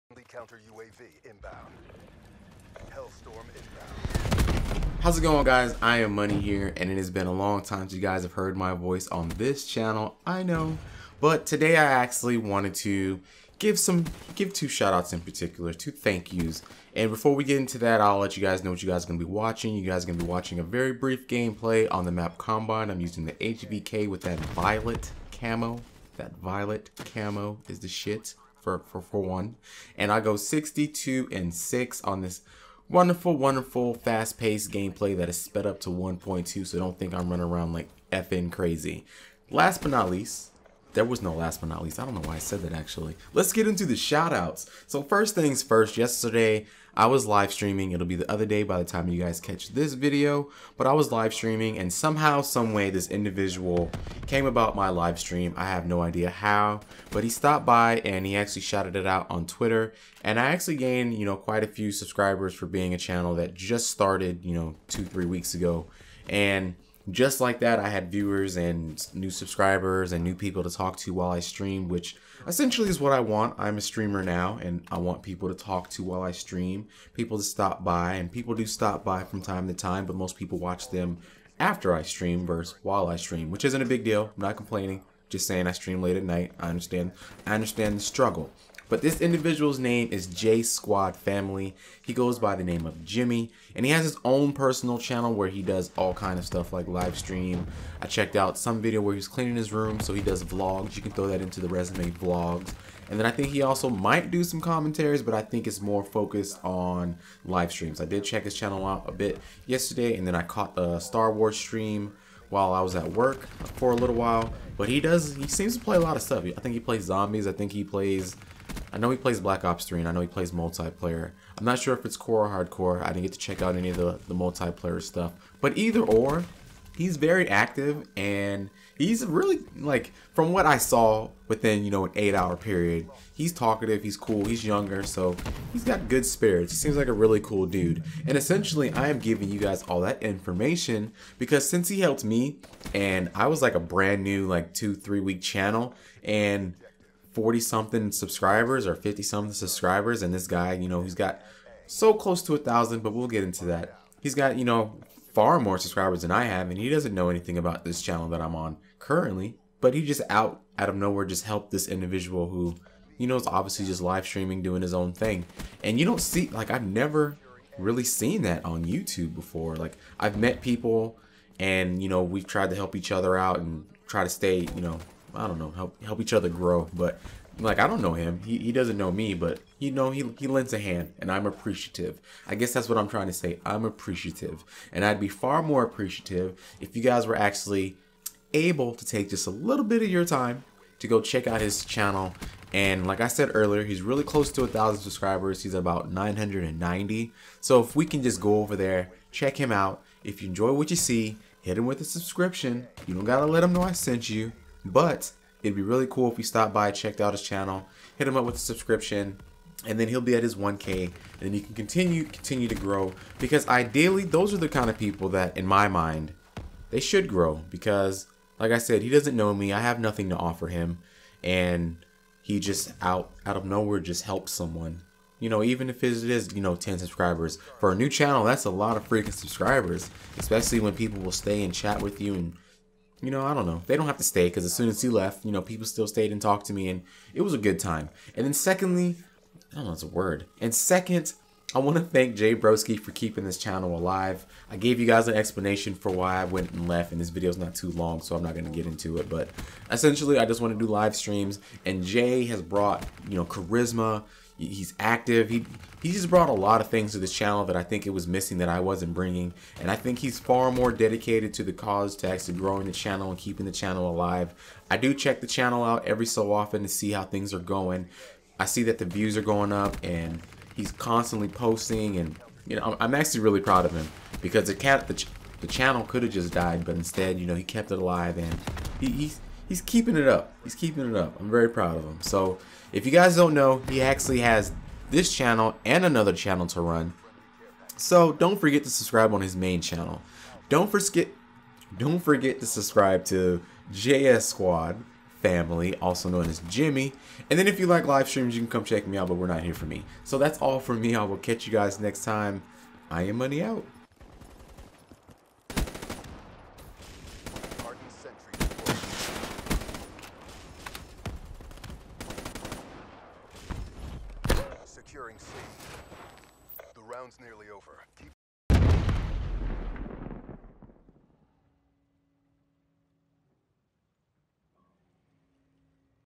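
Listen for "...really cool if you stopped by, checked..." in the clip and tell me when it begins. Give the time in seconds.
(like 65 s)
205 s.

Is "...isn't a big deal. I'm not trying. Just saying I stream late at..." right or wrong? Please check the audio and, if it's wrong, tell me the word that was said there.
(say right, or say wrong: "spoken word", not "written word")
wrong: "complaining", not "trying".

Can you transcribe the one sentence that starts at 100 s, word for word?
You can throw that into the resume vlogs.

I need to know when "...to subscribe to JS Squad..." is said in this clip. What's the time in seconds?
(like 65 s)
292 s.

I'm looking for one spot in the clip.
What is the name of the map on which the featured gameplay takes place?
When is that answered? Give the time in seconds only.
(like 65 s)
22 s.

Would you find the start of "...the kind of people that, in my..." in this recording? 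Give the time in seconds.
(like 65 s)
214 s.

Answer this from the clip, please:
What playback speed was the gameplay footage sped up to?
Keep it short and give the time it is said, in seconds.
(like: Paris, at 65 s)
1.2, at 35 s.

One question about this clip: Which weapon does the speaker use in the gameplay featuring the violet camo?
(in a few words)
HVK.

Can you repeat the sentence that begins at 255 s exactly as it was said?
He he just brought a lot of things to this channel that I think it was missing that I wasn't bringing.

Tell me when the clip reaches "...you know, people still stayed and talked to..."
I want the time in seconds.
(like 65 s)
235 s.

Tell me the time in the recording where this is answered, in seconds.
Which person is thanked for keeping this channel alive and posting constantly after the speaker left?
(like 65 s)
242 s.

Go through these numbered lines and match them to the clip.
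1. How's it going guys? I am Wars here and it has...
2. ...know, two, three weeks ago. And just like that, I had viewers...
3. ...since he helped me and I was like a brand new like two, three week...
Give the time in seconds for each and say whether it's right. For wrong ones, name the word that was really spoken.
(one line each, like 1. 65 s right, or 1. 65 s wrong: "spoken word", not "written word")
1. 5 s wrong: "Money", not "Wars"
2. 64 s right
3. 141 s right.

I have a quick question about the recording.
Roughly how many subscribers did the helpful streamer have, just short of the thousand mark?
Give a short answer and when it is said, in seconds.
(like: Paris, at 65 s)
990, at 196 s.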